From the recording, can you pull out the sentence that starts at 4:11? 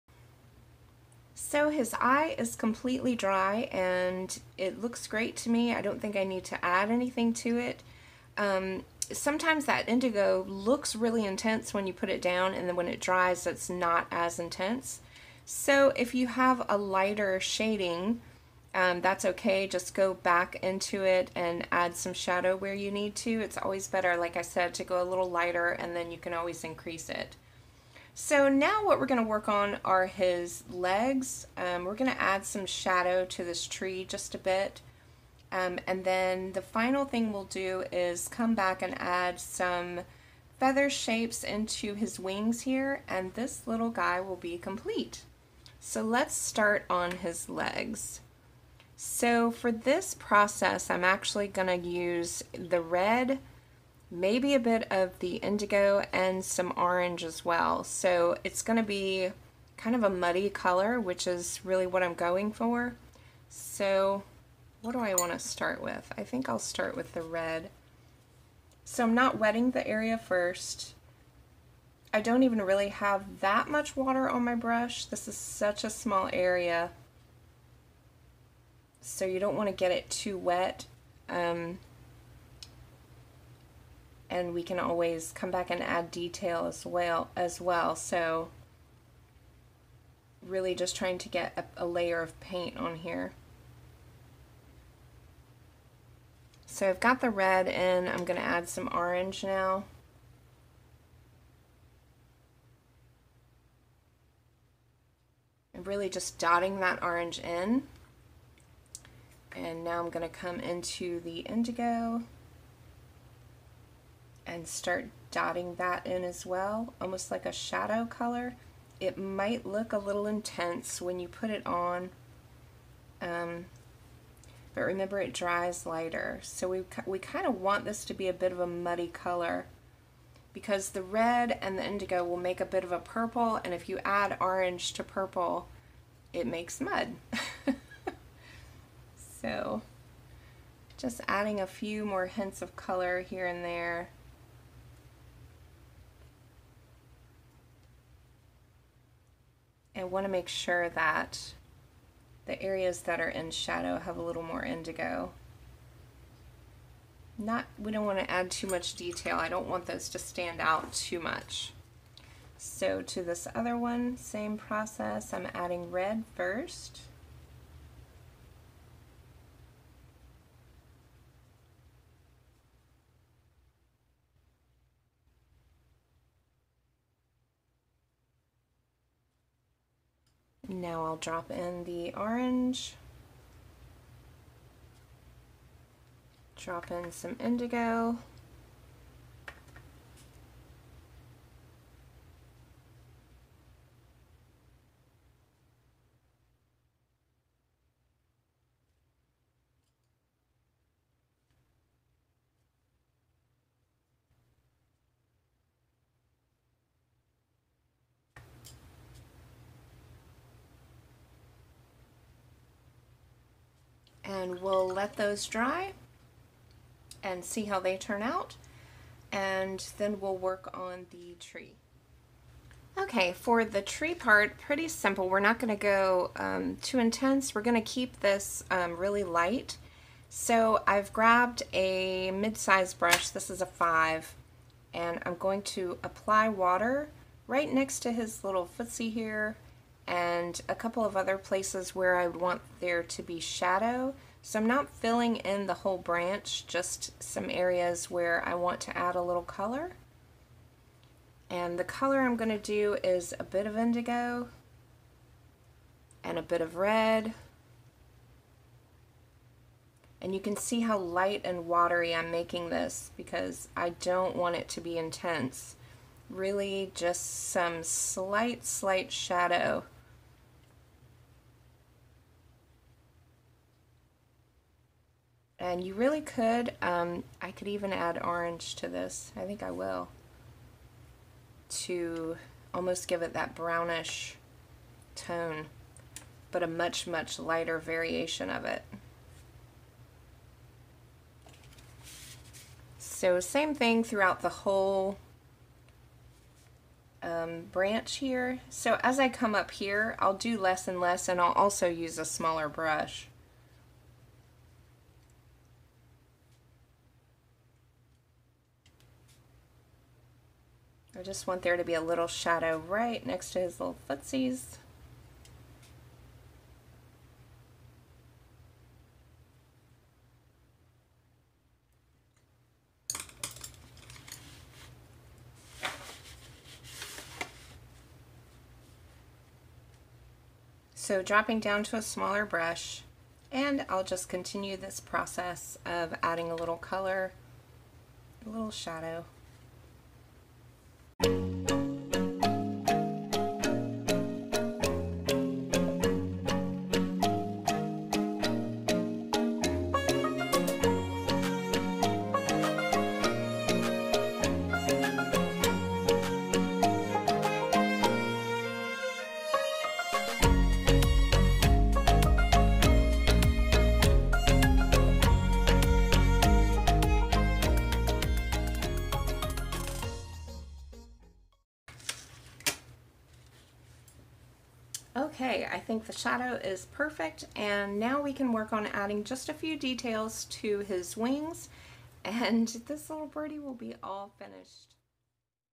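And the color I'm going to do is a bit of indigo and a bit of red.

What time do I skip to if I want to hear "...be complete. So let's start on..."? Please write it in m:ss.
0:44.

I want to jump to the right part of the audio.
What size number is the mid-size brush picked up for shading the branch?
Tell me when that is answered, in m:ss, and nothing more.
3:53.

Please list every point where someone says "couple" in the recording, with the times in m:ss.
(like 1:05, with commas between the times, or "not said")
4:00.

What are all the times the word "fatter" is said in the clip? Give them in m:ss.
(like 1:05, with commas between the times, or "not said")
not said.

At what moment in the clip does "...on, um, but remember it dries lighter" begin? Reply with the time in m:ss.
2:01.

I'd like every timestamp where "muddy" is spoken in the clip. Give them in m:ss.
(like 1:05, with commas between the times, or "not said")
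1:00, 2:08.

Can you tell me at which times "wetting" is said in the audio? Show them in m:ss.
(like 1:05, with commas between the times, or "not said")
1:09.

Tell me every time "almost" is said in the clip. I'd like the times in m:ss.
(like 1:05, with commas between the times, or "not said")
1:56, 4:42.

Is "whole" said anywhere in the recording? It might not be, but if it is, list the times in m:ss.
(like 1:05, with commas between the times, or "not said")
4:05, 4:54.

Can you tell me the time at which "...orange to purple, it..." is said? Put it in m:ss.
2:14.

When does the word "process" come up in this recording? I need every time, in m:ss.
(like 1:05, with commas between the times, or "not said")
0:50, 2:44, 5:35.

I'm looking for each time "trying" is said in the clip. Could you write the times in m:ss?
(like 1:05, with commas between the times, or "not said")
1:30.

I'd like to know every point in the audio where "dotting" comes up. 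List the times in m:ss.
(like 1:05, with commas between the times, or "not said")
1:46, 1:55.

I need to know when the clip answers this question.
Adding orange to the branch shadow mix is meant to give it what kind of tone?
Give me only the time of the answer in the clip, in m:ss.
4:43.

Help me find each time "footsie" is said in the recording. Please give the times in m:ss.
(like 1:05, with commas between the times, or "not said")
3:58, 5:14.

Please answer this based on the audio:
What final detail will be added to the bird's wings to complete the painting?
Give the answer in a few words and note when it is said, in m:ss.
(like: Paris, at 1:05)
Feather shapes, at 0:40.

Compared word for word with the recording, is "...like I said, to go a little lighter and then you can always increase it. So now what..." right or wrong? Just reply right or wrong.
right.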